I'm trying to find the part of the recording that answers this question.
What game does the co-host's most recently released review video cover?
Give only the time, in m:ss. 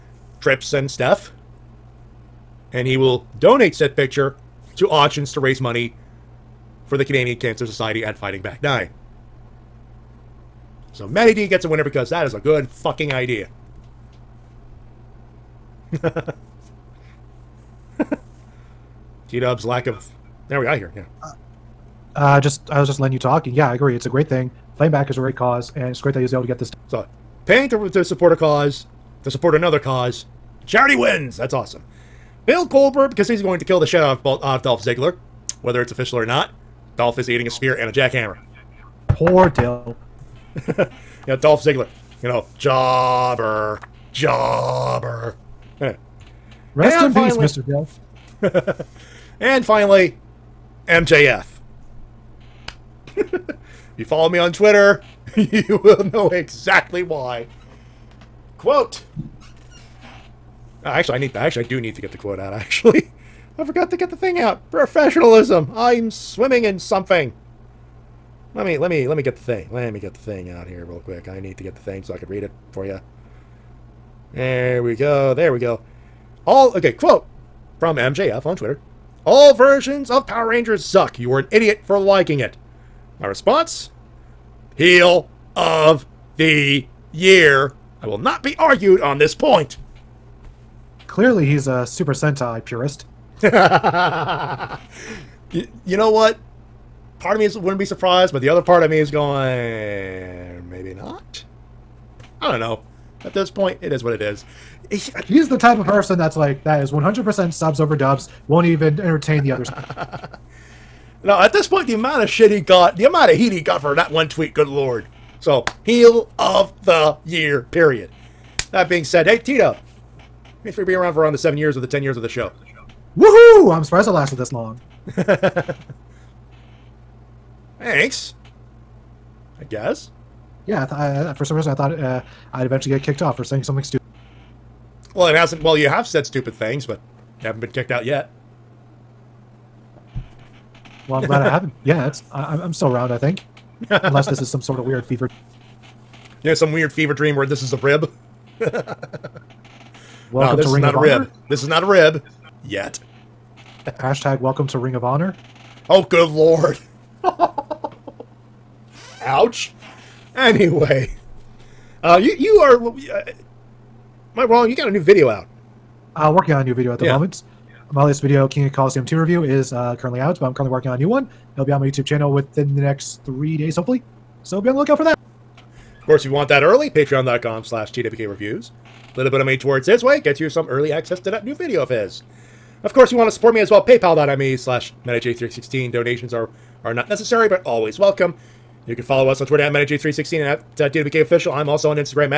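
2:48.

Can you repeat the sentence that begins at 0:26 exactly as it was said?
So, paying to, to support a cause, to support another cause, charity wins.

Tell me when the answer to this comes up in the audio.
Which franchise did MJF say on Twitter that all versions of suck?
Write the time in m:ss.
1:20.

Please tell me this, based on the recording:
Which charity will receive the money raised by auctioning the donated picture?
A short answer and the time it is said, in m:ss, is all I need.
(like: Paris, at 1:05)
Canadian Cancer Society, at 0:07.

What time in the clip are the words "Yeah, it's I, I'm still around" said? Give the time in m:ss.
2:21.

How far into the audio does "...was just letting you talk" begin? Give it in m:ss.
0:22.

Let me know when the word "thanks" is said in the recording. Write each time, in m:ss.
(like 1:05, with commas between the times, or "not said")
2:00, 2:07.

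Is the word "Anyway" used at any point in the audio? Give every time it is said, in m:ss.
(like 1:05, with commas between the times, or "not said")
0:45, 2:40.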